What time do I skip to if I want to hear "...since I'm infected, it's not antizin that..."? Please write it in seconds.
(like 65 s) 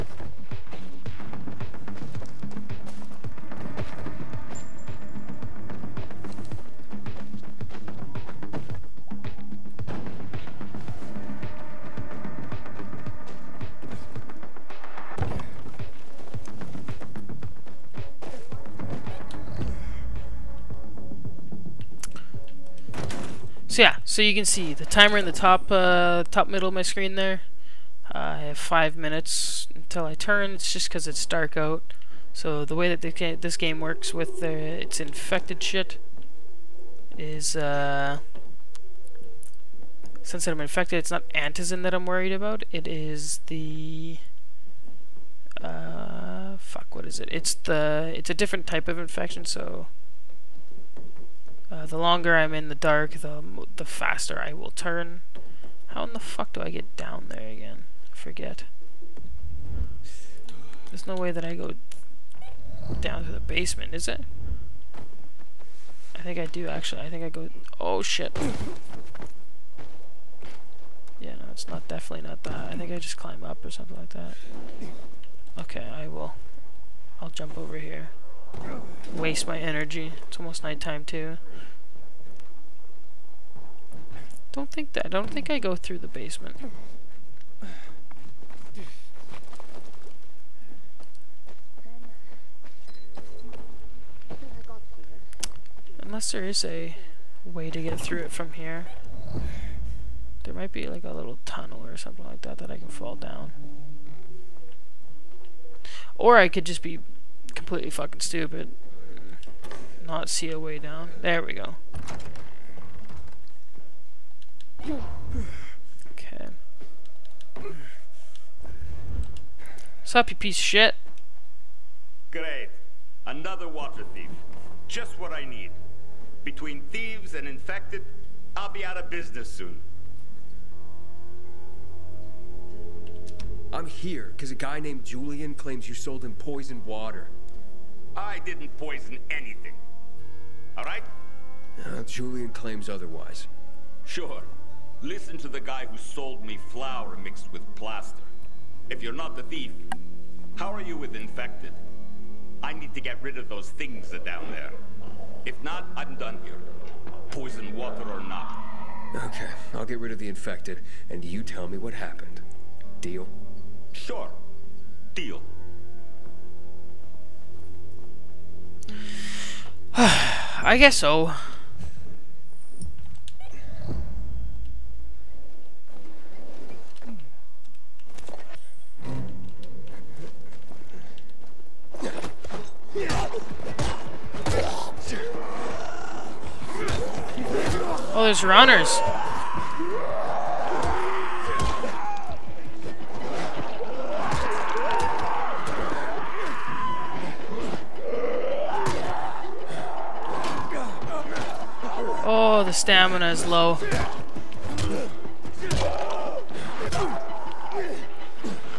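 40 s.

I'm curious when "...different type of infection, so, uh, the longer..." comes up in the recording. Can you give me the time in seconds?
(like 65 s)
48 s.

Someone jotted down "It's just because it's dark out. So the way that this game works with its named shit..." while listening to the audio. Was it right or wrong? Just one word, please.
wrong.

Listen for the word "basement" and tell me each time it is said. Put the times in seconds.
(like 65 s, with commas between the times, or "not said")
63 s, 86 s.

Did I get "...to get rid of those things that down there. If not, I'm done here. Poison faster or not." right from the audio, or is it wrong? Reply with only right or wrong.
wrong.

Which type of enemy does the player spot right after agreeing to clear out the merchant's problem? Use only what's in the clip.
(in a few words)
Runners.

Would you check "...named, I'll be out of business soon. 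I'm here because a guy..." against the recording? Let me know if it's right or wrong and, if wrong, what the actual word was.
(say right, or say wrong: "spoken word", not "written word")
wrong: "infected", not "named".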